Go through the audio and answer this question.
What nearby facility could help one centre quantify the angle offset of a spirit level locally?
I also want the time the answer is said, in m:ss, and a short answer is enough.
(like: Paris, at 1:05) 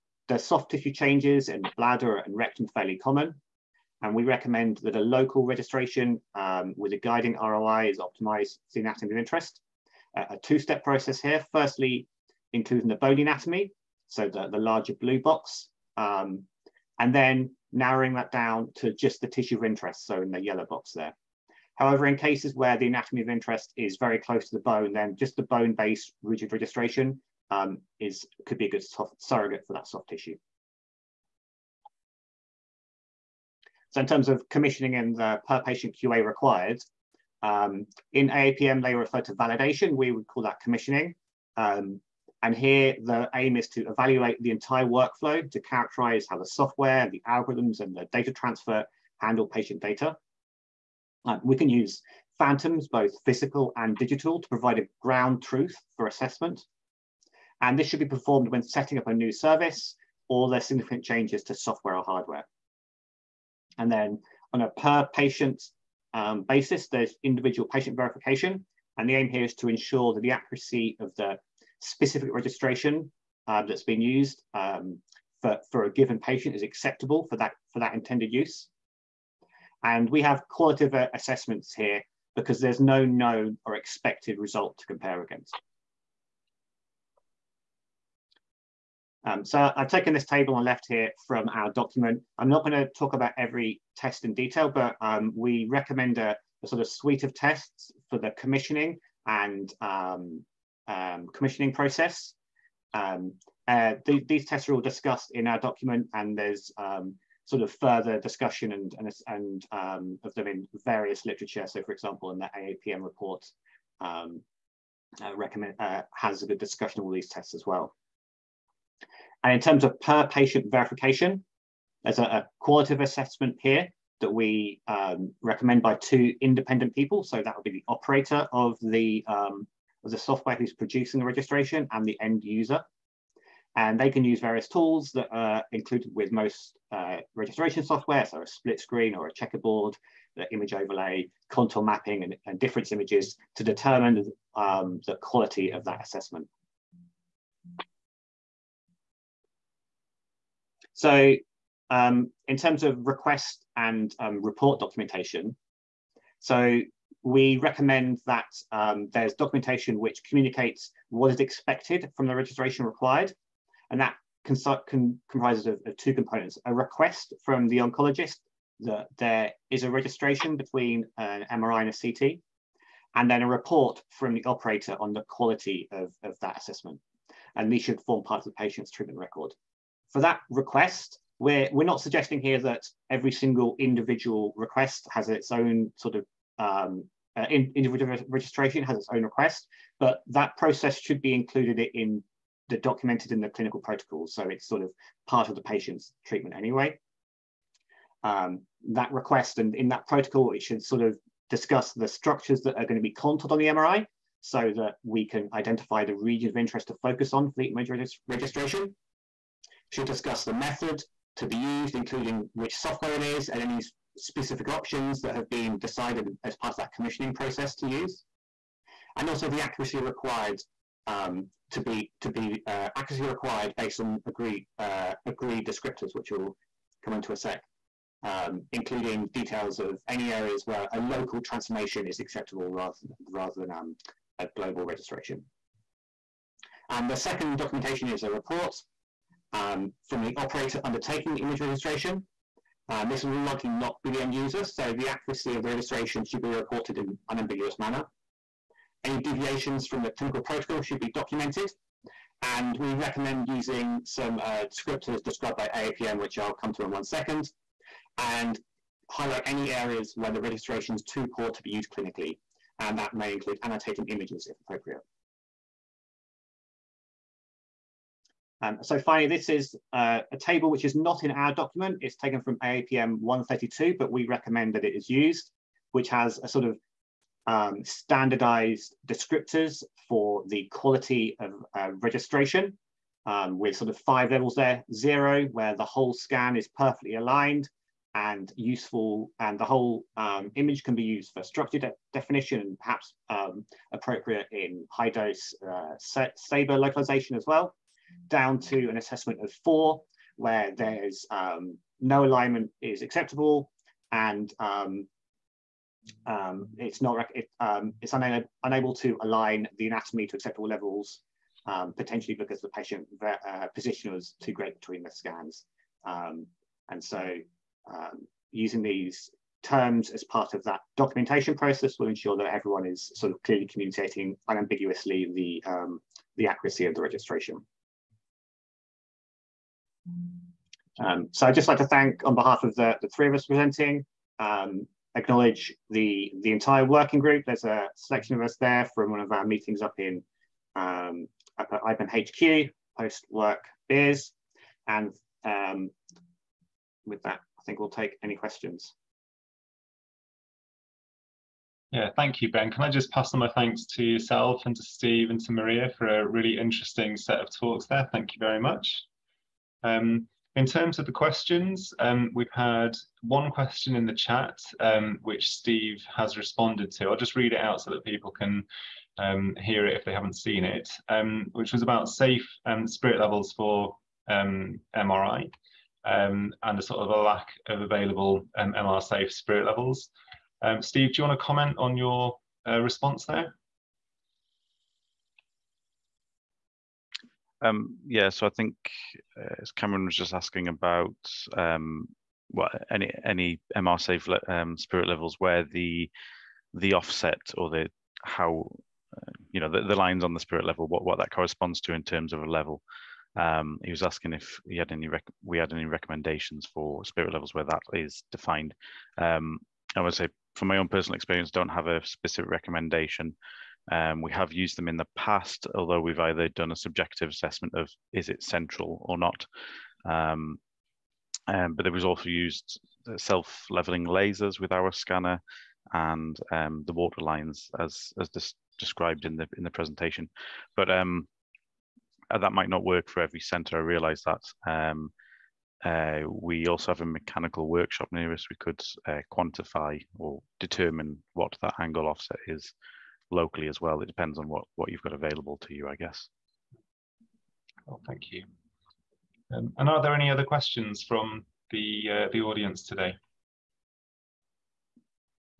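mechanical workshop, at 7:17.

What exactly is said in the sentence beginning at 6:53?
Um, we have used them in the past, although we've either done a subjective assessment of is it central or not.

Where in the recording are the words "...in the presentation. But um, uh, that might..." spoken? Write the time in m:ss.
7:09.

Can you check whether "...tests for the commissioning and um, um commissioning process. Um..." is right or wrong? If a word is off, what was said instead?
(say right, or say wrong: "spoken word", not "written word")
right.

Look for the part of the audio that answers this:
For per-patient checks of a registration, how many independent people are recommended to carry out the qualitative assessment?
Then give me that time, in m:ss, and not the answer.
2:05.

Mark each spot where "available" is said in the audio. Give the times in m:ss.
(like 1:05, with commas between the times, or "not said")
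6:17, 7:25.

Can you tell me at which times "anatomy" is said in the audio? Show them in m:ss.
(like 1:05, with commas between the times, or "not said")
0:08, 0:13, 0:22, 5:09.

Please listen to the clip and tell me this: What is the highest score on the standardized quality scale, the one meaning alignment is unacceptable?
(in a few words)
4.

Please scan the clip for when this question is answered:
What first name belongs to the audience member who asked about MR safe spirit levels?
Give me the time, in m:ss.
6:29.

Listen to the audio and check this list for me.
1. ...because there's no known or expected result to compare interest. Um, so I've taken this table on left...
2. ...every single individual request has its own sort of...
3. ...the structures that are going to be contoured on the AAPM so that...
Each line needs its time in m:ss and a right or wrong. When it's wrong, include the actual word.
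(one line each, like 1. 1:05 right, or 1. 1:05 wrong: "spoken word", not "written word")
1. 1:22 wrong: "against", not "interest"
2. 3:03 right
3. 3:21 wrong: "MRI", not "AAPM".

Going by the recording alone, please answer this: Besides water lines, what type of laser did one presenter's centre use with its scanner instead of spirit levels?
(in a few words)
self-leveling lasers.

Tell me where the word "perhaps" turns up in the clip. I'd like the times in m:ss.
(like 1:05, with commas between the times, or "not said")
4:52.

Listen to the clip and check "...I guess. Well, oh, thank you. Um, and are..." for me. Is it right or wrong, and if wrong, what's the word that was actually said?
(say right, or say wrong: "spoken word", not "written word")
right.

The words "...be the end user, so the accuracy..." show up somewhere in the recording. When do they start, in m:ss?
4:04.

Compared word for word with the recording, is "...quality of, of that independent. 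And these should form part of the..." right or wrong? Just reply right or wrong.
wrong.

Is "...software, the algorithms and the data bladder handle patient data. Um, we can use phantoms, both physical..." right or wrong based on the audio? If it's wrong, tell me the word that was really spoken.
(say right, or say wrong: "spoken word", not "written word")
wrong: "transfer", not "bladder".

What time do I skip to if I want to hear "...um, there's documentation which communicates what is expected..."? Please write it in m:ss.
2:38.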